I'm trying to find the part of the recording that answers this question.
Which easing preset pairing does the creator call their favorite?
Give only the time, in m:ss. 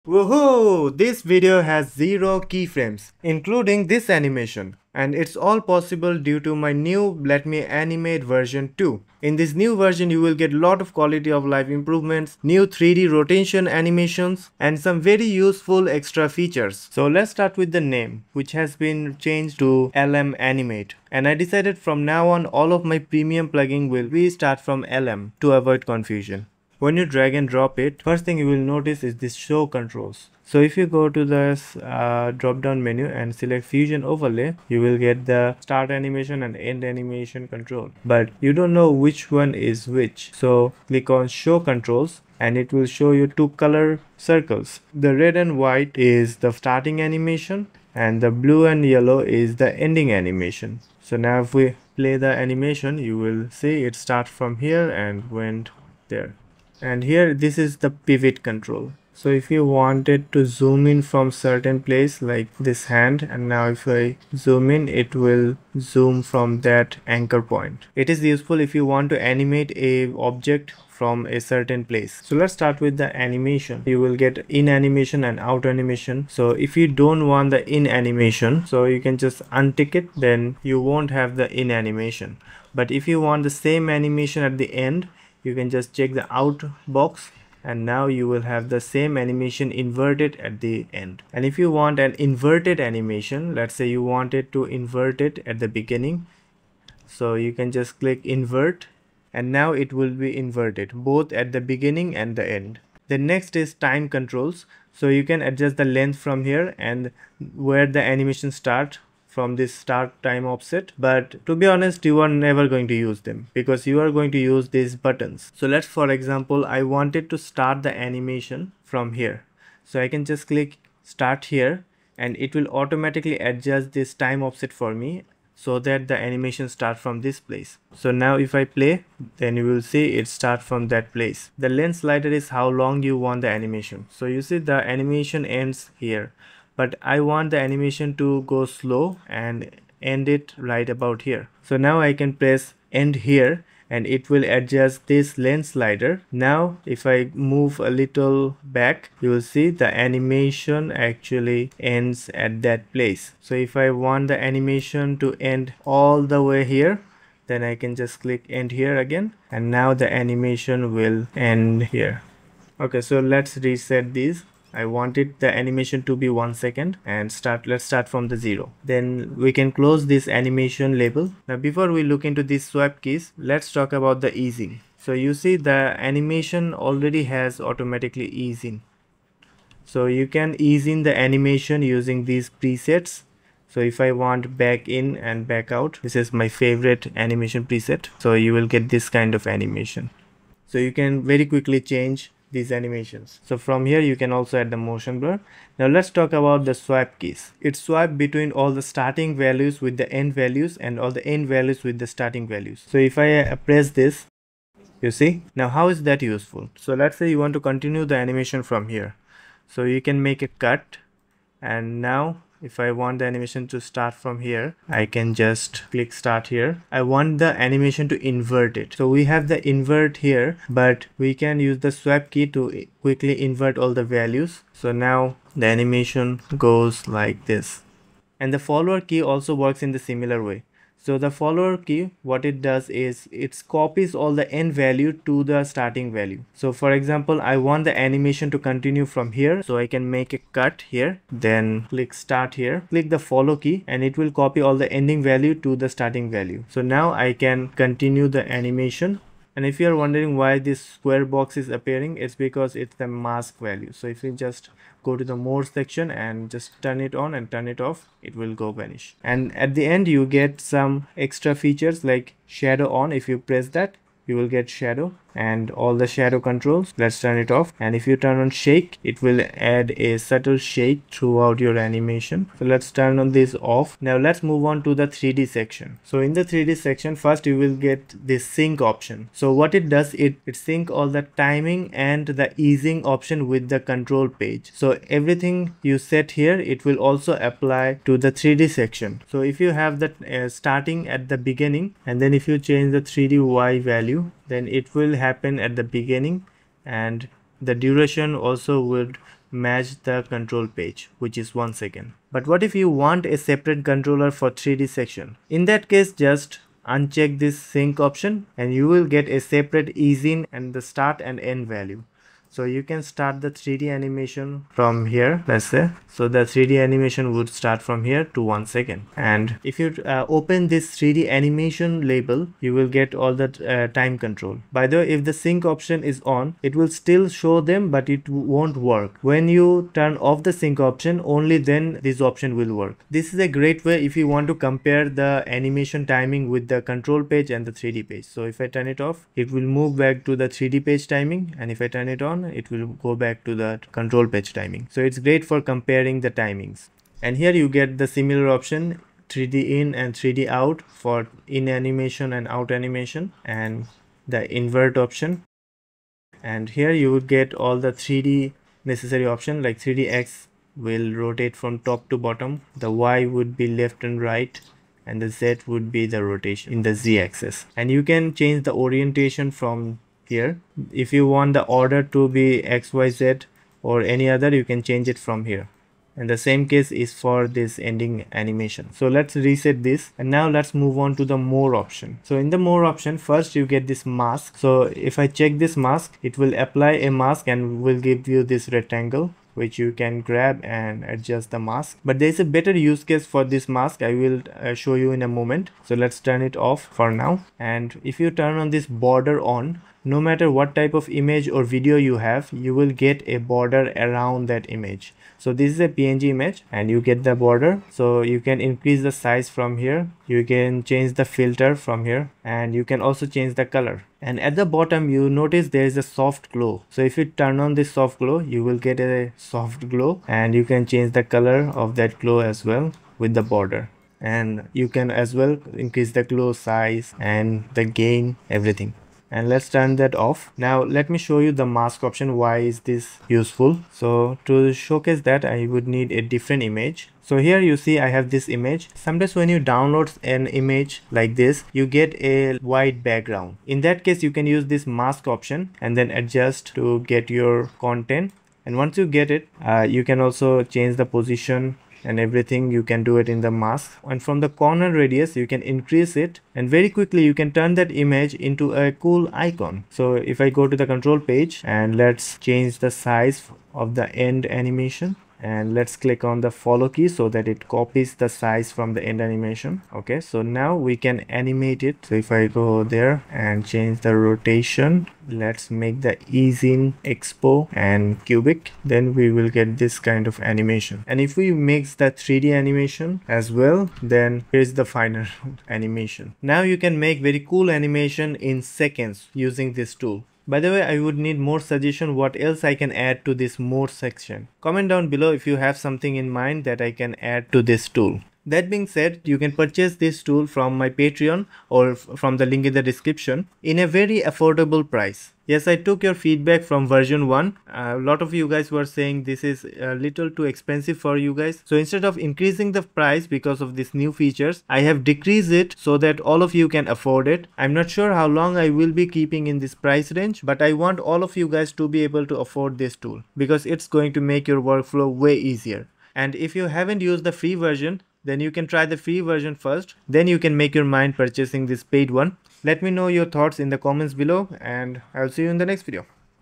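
3:04.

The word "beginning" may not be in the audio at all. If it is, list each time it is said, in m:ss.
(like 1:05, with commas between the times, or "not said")
1:35, 1:41, 4:51, 4:55.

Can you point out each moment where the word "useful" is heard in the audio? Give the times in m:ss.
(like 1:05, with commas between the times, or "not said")
0:15, 1:08, 3:26, 7:13.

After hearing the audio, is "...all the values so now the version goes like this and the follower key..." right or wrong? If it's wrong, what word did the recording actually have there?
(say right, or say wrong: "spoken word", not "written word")
wrong: "animation", not "version".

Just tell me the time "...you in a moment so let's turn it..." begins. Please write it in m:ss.
6:35.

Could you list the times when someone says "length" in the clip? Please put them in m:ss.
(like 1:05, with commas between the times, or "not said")
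1:45, 2:11, 2:25.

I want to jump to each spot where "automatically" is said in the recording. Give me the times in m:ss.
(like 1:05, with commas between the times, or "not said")
2:02, 2:57.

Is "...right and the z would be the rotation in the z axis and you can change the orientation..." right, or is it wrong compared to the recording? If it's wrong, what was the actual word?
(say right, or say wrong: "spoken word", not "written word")
right.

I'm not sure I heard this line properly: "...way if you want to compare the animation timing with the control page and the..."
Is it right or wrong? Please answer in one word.
right.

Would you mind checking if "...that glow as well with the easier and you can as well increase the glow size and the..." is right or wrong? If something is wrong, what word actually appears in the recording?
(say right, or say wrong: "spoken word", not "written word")
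wrong: "border", not "easier".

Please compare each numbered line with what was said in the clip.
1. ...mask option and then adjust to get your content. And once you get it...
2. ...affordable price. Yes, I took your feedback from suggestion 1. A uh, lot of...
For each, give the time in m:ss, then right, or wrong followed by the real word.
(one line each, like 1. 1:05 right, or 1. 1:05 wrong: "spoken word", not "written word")
1. 7:24 right
2. 8:24 wrong: "version", not "suggestion".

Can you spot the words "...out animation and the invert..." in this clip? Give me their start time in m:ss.
5:52.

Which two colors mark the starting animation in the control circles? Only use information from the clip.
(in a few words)
red and white.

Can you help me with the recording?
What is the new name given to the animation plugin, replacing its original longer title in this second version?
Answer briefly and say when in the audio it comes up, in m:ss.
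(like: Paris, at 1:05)
LM Animate, at 0:19.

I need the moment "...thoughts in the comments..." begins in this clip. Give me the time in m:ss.
8:53.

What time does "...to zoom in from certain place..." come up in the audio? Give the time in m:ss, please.
1:00.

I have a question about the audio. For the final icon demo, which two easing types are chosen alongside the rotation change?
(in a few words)
expo and cubic.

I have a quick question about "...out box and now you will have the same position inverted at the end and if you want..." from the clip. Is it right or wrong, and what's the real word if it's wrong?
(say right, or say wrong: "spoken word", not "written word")
wrong: "animation", not "position".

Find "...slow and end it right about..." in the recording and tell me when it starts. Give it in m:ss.
2:18.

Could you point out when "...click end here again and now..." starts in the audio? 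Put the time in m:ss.
2:38.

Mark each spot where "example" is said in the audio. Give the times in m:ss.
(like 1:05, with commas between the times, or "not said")
1:56, 3:56.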